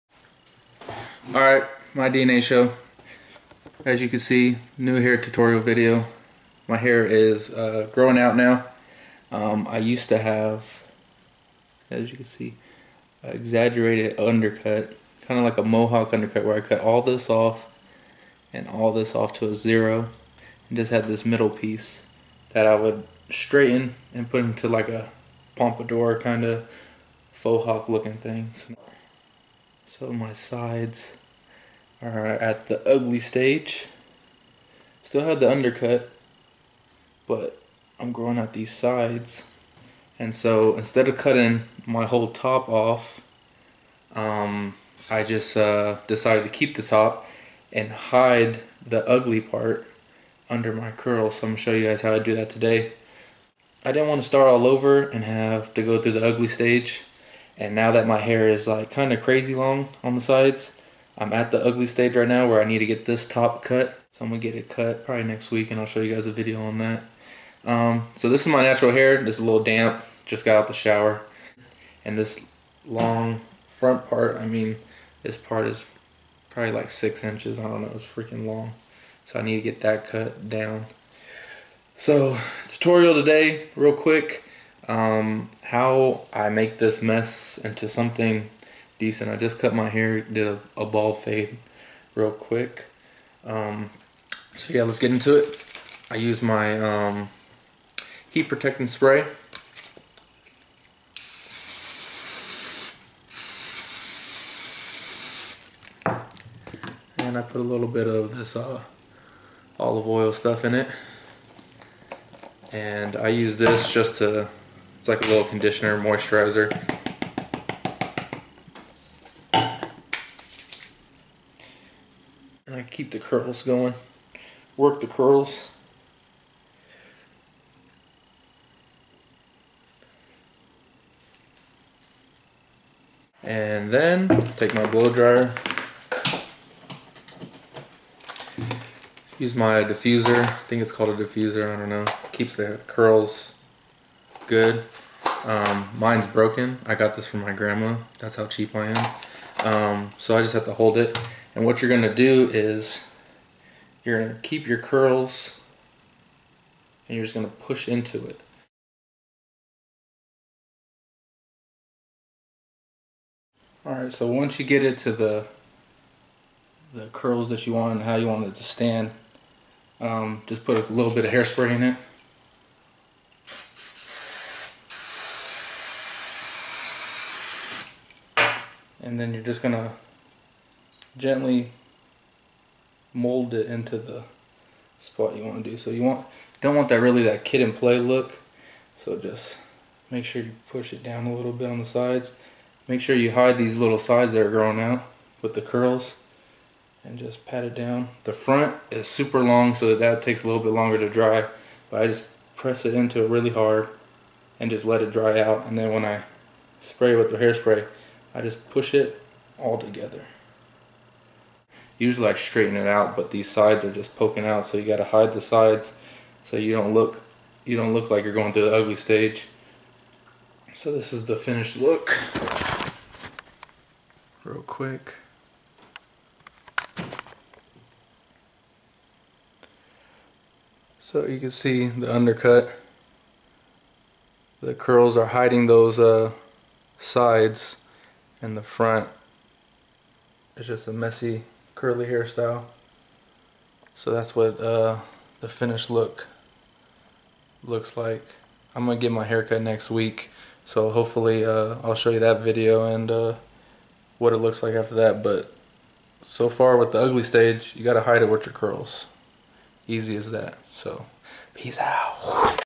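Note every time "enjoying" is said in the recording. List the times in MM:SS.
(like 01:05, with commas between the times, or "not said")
not said.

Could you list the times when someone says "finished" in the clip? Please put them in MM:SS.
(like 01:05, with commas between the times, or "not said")
03:41, 04:05.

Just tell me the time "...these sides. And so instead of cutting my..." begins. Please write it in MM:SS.
00:38.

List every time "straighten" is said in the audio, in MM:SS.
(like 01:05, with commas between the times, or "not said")
00:23, 03:32.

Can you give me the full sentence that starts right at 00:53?
I didn't want to start all over and have to go through the ugly stage.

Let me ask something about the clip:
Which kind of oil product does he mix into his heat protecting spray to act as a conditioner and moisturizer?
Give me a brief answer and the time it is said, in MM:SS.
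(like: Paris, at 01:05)
Olive oil, at 01:49.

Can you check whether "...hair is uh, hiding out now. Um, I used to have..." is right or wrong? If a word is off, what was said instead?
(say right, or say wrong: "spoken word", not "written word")
wrong: "growing", not "hiding".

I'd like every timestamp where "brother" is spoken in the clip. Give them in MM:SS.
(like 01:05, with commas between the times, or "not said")
not said.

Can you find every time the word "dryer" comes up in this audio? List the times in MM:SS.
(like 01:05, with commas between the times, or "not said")
02:15.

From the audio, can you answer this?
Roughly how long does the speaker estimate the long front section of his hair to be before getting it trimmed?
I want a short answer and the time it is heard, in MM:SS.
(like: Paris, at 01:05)
6 inches, at 01:16.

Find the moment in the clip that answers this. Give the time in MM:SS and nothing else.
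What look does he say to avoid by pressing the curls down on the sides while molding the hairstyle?
03:07.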